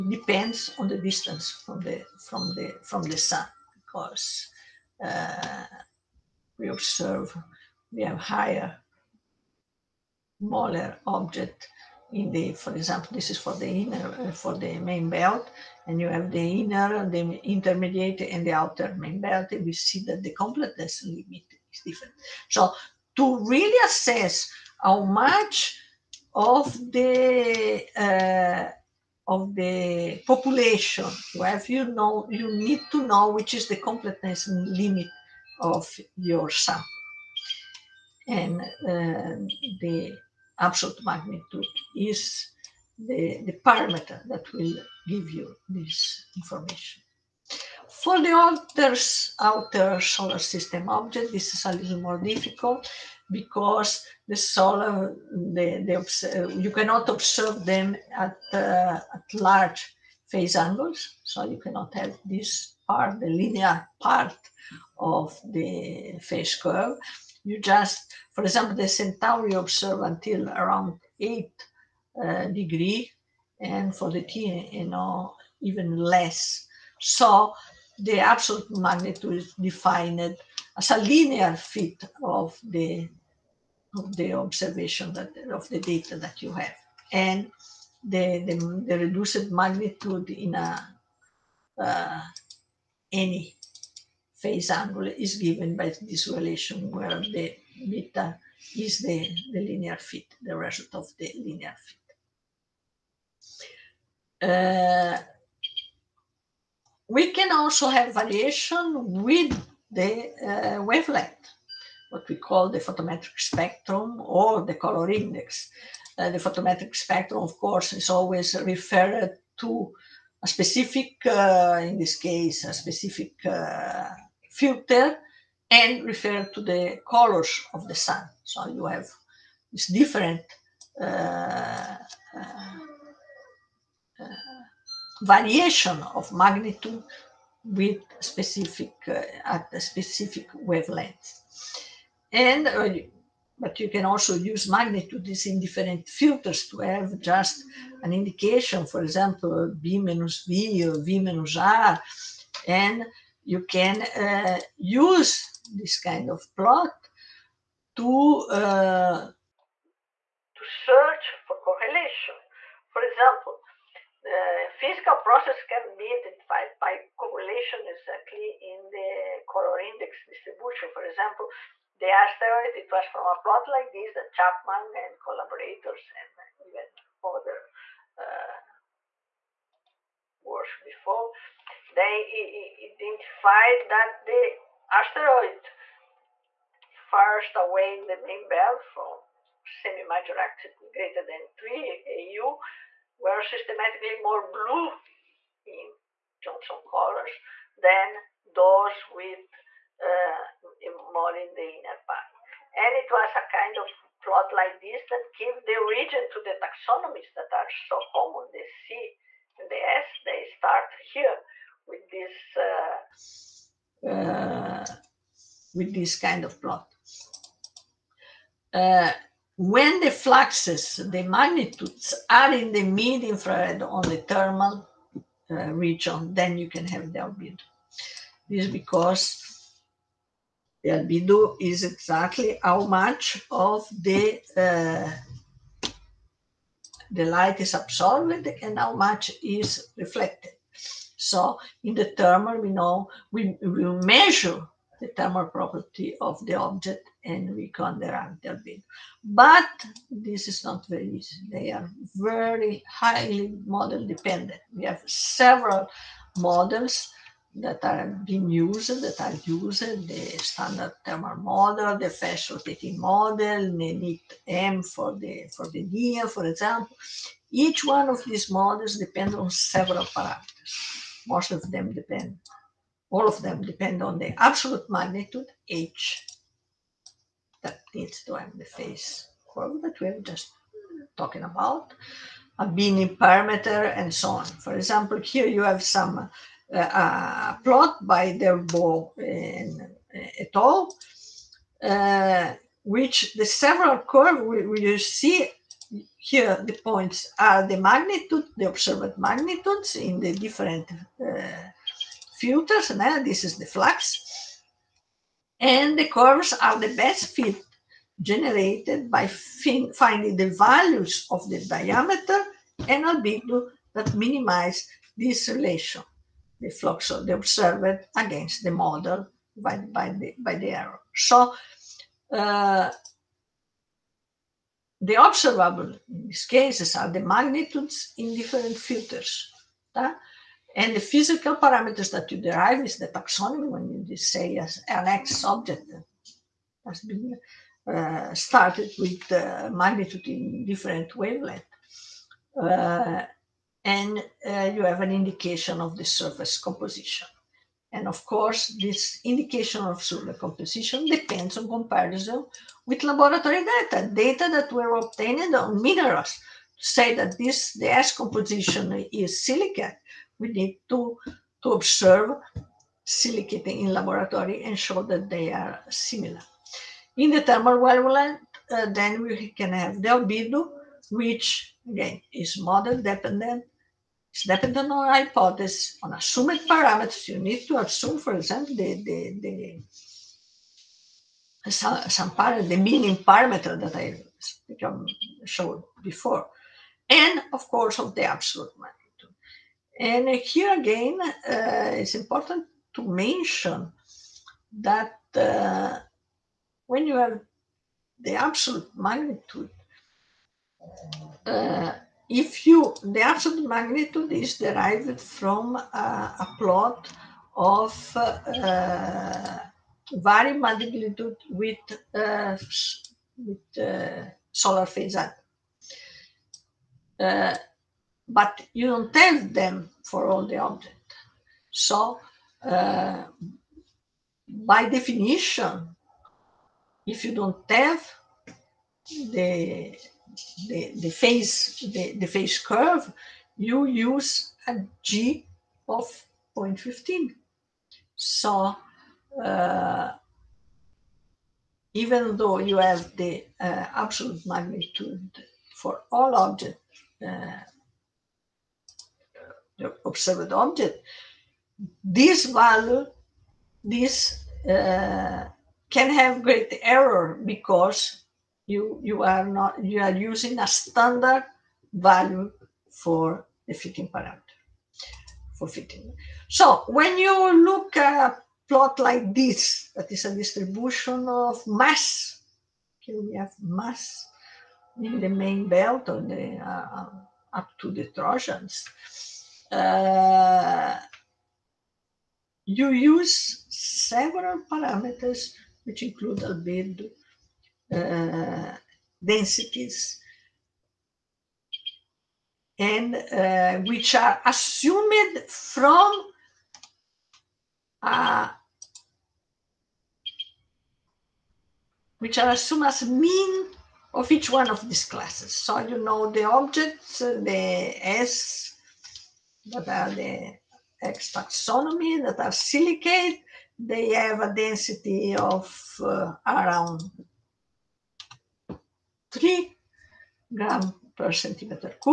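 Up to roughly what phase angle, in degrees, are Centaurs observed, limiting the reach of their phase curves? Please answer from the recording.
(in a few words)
8.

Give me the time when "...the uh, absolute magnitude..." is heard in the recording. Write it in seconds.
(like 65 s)
443 s.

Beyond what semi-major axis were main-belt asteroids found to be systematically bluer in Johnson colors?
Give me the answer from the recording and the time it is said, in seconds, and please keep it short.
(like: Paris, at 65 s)
3 AU, at 191 s.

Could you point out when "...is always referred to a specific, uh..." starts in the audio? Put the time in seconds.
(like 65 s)
117 s.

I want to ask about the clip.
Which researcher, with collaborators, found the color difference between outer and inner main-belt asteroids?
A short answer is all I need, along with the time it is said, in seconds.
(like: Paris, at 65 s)
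Chapman, at 174 s.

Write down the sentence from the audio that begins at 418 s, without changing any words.
but you don't tell them for all the objects.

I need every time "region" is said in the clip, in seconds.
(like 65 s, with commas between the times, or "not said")
225 s.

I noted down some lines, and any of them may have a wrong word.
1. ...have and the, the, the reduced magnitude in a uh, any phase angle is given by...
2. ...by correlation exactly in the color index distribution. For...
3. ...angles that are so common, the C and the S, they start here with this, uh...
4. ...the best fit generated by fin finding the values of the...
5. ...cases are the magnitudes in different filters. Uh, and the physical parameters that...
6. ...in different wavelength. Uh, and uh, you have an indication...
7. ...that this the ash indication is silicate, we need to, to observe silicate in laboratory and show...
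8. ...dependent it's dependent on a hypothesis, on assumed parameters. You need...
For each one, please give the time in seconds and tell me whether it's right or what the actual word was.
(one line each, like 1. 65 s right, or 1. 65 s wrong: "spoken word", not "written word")
1. 86 s right
2. 166 s right
3. 206 s wrong: "taxonomies", not "angles"
4. 306 s right
5. 326 s right
6. 340 s right
7. 357 s wrong: "composition", not "indication"
8. 373 s right.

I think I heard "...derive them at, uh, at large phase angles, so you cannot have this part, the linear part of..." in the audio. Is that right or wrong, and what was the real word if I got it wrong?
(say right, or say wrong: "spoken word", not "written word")
wrong: "observe", not "derive".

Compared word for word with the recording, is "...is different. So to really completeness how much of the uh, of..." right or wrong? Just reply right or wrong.
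wrong.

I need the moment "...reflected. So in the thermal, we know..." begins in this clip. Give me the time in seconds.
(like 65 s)
239 s.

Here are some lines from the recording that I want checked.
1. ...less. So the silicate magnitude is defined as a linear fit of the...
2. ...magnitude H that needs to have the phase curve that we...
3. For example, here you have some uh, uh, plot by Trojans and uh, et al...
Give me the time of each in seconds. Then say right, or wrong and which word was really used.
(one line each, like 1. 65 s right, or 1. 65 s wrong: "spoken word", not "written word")
1. 75 s wrong: "absolute", not "silicate"
2. 274 s right
3. 284 s wrong: "Delbo", not "Trojans".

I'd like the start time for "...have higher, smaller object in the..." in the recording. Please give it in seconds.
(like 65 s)
8 s.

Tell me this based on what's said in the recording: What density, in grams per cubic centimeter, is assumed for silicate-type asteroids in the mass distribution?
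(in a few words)
3.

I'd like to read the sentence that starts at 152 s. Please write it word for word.
And you can uh, use this kind of plot to, uh, to search for correlation.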